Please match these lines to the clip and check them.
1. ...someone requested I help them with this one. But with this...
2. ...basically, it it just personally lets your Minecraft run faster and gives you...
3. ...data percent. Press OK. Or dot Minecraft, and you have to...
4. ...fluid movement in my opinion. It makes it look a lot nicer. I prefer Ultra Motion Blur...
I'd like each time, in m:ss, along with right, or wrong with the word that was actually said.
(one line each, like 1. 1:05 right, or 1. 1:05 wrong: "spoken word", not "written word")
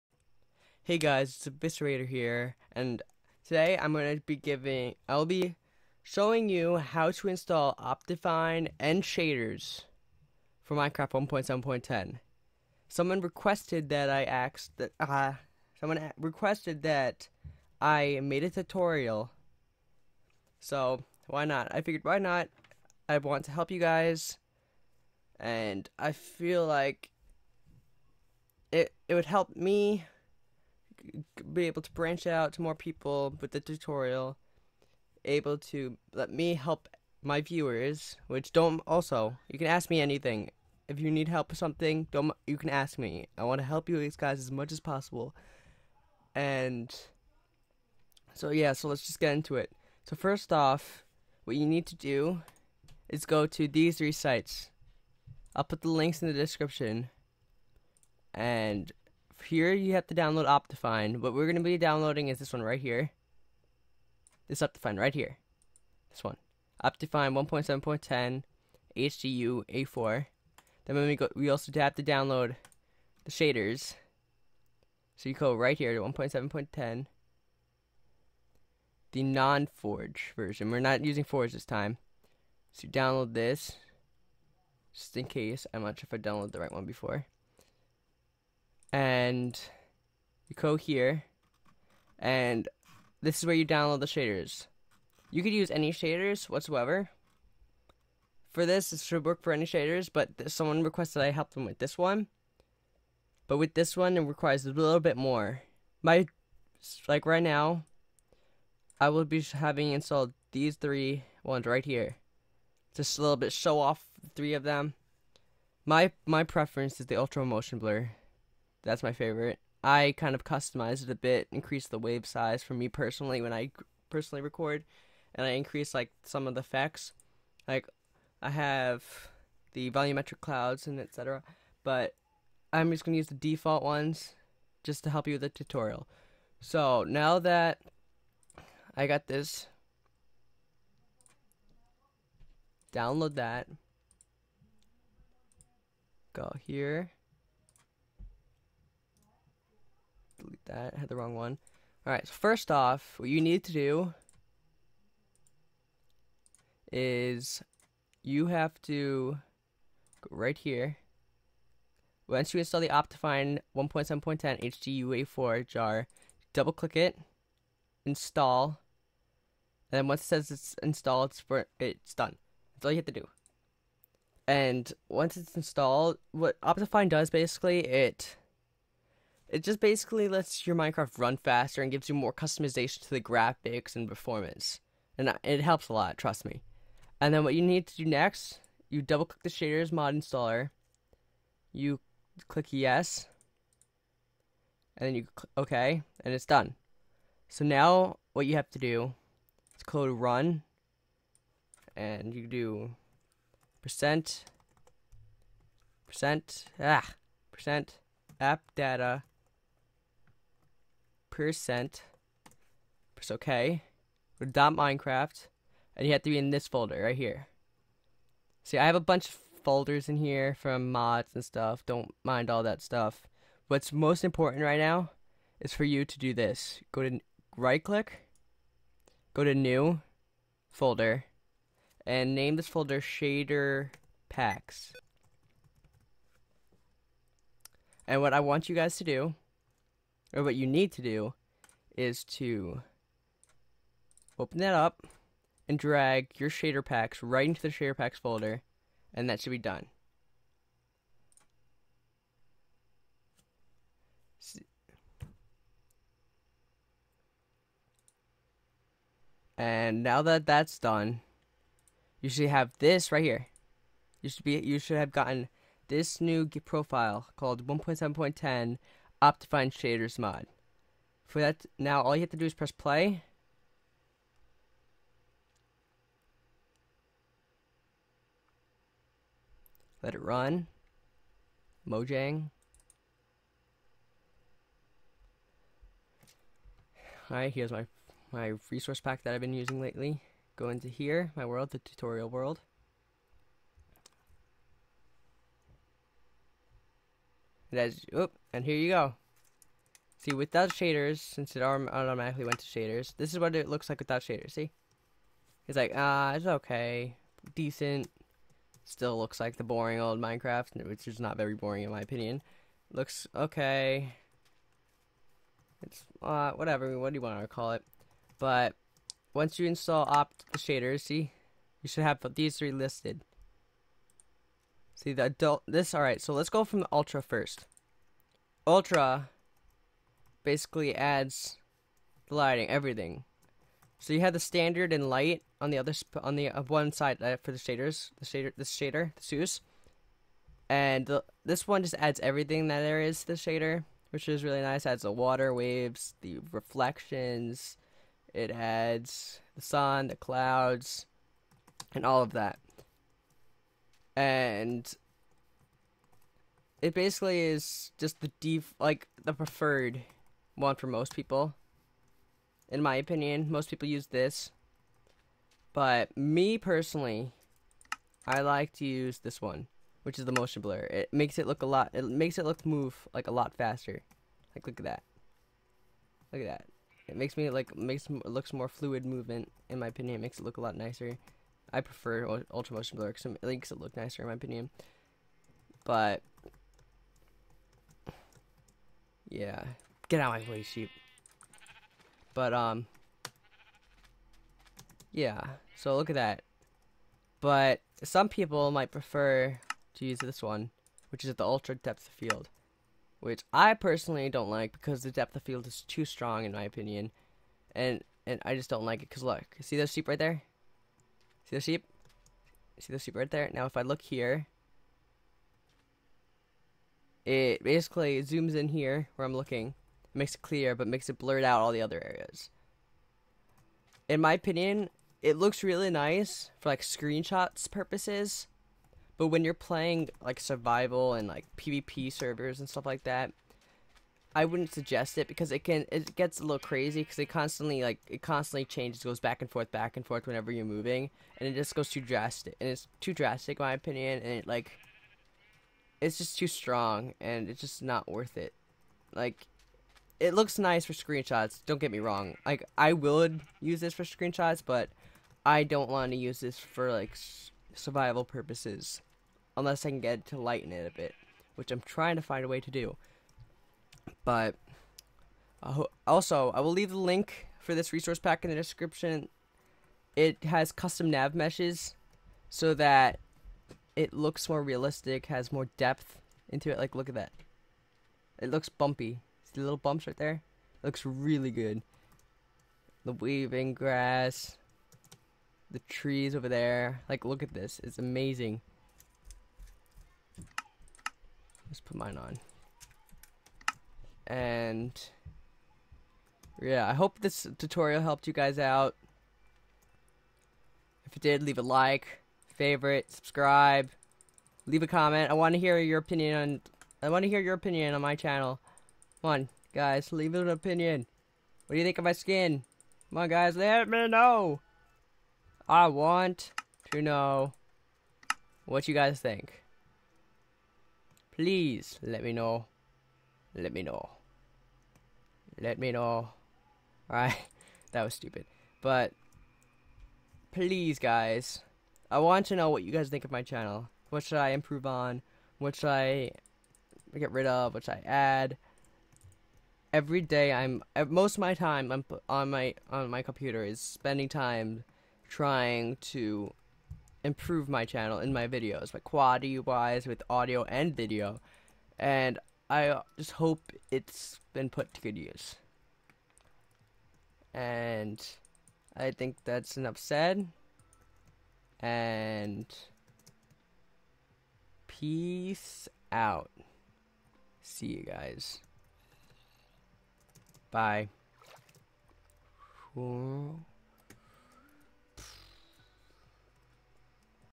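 1. 1:40 right
2. 2:57 wrong: "basically", not "personally"
3. 3:28 right
4. 6:18 right.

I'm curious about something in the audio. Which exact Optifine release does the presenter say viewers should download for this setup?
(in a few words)
Optifine 1.7.10 HDU A4.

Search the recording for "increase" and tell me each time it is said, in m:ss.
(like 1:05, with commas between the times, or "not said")
2:01, 2:05.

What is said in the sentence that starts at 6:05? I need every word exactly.
But me personally, I like to use this one, which is the motion blur.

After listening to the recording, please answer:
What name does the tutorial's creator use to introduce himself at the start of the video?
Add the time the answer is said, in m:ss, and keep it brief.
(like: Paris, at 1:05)
Eviscerator, at 0:01.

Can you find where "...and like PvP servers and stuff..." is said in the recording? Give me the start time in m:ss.
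7:11.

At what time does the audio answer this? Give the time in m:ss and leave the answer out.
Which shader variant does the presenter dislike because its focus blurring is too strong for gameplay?
6:41.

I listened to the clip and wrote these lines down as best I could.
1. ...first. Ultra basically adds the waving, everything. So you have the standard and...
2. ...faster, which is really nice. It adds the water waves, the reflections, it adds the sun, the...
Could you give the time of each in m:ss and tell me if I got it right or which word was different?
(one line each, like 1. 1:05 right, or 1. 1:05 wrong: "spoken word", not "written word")
1. 5:27 wrong: "lighting", not "waving"
2. 5:43 wrong: "shader", not "faster".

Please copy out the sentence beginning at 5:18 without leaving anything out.
But once you install opt the shaders, see, you should have these three listed.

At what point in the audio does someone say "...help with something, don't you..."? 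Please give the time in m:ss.
0:41.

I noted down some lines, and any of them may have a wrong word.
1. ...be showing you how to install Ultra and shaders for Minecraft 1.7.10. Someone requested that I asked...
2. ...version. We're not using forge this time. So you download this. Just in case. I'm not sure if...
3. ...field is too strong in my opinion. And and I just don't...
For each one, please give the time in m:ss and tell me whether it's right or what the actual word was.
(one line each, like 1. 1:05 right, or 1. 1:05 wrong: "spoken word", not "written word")
1. 0:05 wrong: "Optifine", not "Ultra"
2. 1:20 right
3. 6:45 right.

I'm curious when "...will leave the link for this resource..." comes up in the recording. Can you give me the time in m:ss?
7:46.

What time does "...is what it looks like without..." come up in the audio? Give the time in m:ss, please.
5:03.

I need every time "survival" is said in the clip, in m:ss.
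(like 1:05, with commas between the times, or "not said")
7:10, 7:37.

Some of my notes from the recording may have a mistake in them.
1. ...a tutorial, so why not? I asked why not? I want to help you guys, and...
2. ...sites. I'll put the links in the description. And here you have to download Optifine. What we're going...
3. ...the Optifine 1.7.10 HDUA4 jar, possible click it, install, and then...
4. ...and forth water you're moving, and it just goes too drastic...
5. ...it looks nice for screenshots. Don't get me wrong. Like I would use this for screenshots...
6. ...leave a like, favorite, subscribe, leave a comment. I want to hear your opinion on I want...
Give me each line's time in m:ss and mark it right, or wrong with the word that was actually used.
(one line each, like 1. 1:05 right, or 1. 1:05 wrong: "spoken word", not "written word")
1. 0:18 wrong: "figured", not "asked"
2. 0:54 right
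3. 2:42 wrong: "double", not "possible"
4. 7:19 wrong: "whenever", not "water"
5. 7:30 right
6. 8:21 right.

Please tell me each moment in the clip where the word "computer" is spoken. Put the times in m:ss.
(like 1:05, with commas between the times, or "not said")
9:03.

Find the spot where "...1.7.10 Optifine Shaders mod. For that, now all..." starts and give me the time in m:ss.
4:27.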